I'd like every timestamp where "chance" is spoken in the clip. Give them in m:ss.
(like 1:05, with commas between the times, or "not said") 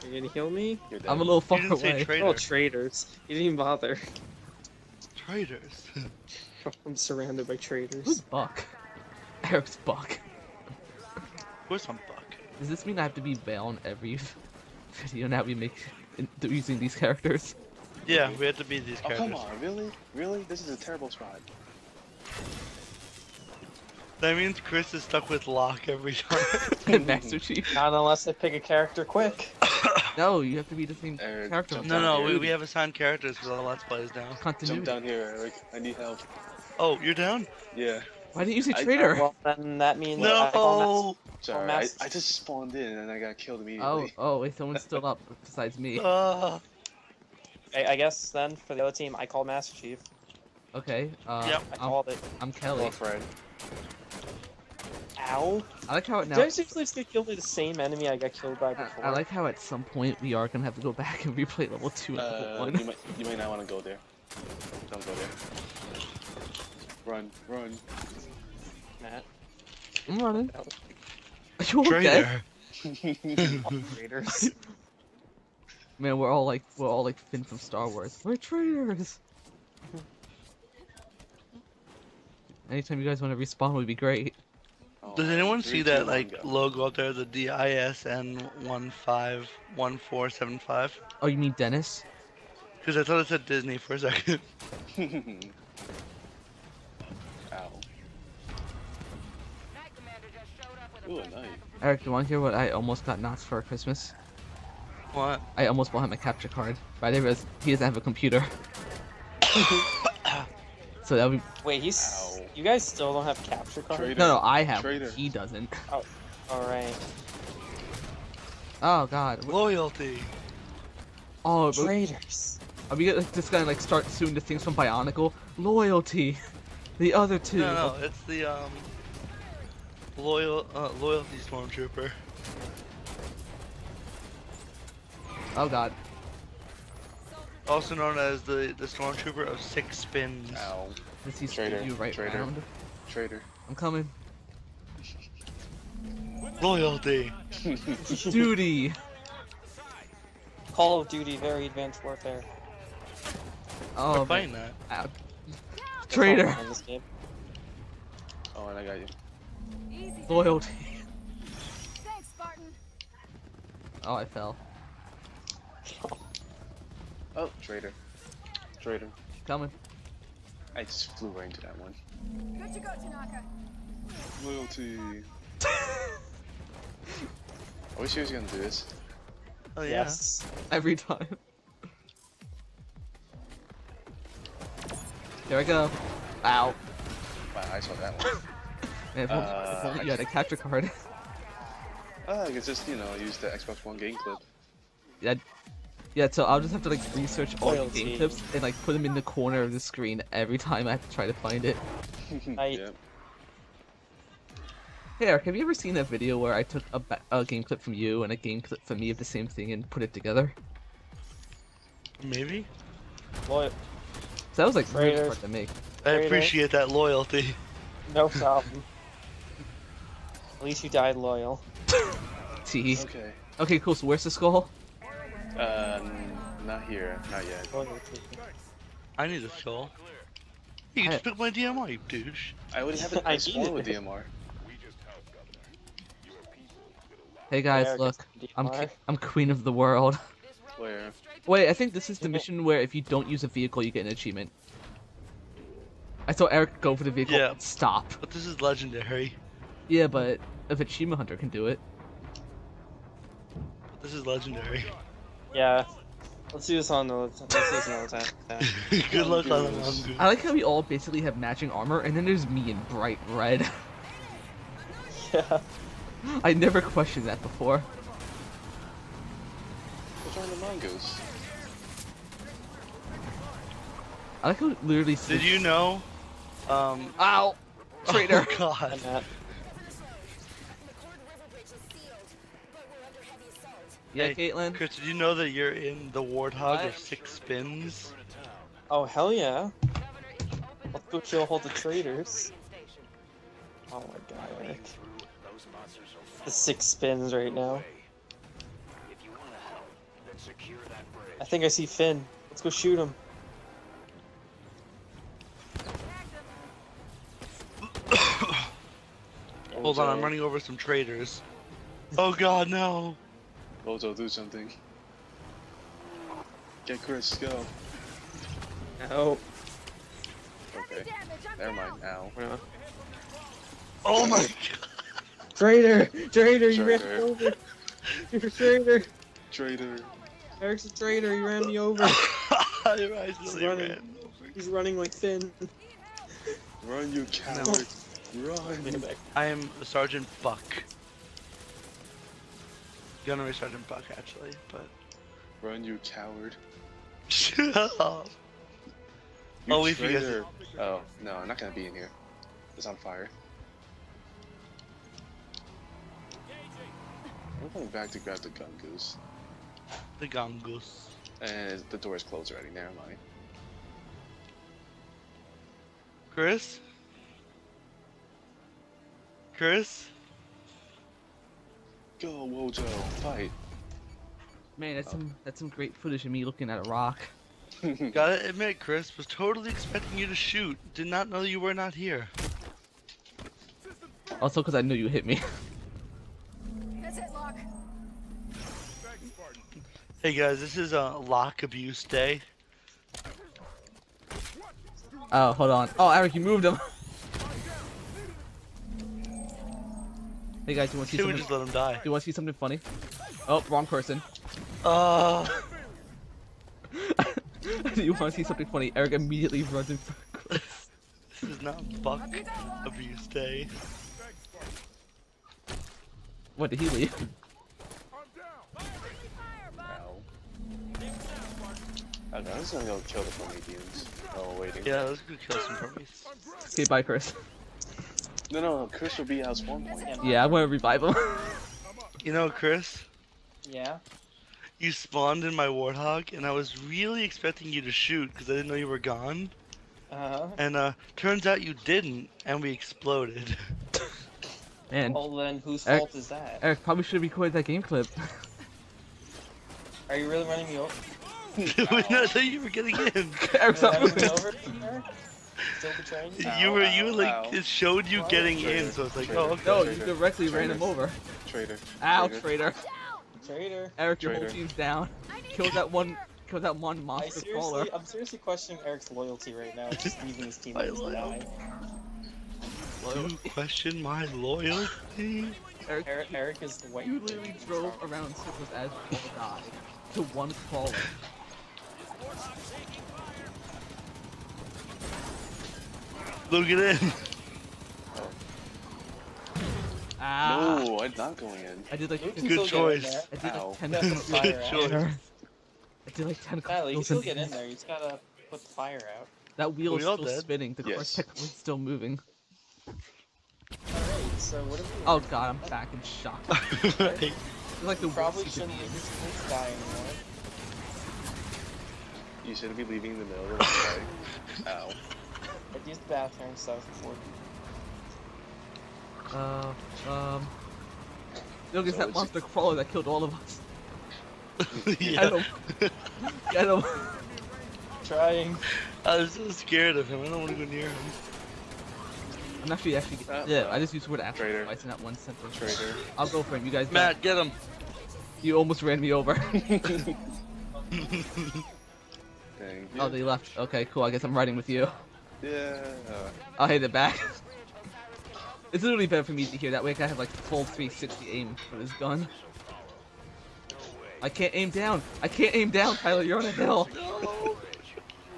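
not said.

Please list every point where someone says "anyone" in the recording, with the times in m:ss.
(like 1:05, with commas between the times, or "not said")
1:25.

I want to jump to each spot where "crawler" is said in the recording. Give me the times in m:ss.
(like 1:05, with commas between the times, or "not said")
8:00, 8:42.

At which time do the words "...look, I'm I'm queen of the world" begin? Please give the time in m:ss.
3:57.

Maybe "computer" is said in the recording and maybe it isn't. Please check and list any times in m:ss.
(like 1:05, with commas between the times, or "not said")
1:48.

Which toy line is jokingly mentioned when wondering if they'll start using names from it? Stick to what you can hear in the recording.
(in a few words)
Bionicle.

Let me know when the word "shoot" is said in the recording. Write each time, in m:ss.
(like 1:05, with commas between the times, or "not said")
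5:02, 6:20, 7:17.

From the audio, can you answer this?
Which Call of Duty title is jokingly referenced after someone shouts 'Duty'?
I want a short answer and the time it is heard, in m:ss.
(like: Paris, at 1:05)
Advanced Warfare, at 2:31.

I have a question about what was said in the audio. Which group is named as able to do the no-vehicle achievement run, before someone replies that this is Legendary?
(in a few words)
Achievement Hunter.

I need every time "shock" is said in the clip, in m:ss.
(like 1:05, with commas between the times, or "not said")
8:26.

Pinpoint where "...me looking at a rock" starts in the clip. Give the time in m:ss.
6:16.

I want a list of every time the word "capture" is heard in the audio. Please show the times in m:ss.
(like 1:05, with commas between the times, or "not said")
1:46, 1:53, 3:10.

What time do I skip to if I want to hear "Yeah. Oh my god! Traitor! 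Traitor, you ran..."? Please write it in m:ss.
5:22.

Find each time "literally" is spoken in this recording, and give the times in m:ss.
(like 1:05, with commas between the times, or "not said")
4:34, 7:57, 9:08.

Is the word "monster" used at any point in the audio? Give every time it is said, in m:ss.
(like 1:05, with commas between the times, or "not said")
7:47, 8:42.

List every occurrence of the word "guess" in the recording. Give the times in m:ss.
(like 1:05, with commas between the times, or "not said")
0:47, 9:04.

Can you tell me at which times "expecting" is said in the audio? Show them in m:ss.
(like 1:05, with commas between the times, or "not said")
6:19, 7:17.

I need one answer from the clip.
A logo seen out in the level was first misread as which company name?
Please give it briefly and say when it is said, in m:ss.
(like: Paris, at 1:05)
Disney, at 1:33.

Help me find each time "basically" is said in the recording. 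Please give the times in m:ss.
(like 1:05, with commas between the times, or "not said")
4:20.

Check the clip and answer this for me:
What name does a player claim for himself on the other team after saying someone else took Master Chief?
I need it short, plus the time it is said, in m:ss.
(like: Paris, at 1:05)
Kelly, at 0:52.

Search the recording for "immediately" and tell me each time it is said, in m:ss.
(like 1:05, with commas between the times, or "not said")
0:43, 6:49.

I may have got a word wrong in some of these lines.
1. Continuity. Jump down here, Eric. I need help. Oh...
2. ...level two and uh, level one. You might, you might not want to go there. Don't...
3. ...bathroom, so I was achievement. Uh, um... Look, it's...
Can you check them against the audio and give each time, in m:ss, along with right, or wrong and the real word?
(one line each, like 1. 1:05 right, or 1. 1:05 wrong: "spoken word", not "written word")
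1. 0:34 right
2. 1:01 right
3. 8:36 wrong: "important", not "achievement".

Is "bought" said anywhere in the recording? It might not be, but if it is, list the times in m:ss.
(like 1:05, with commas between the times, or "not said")
1:45.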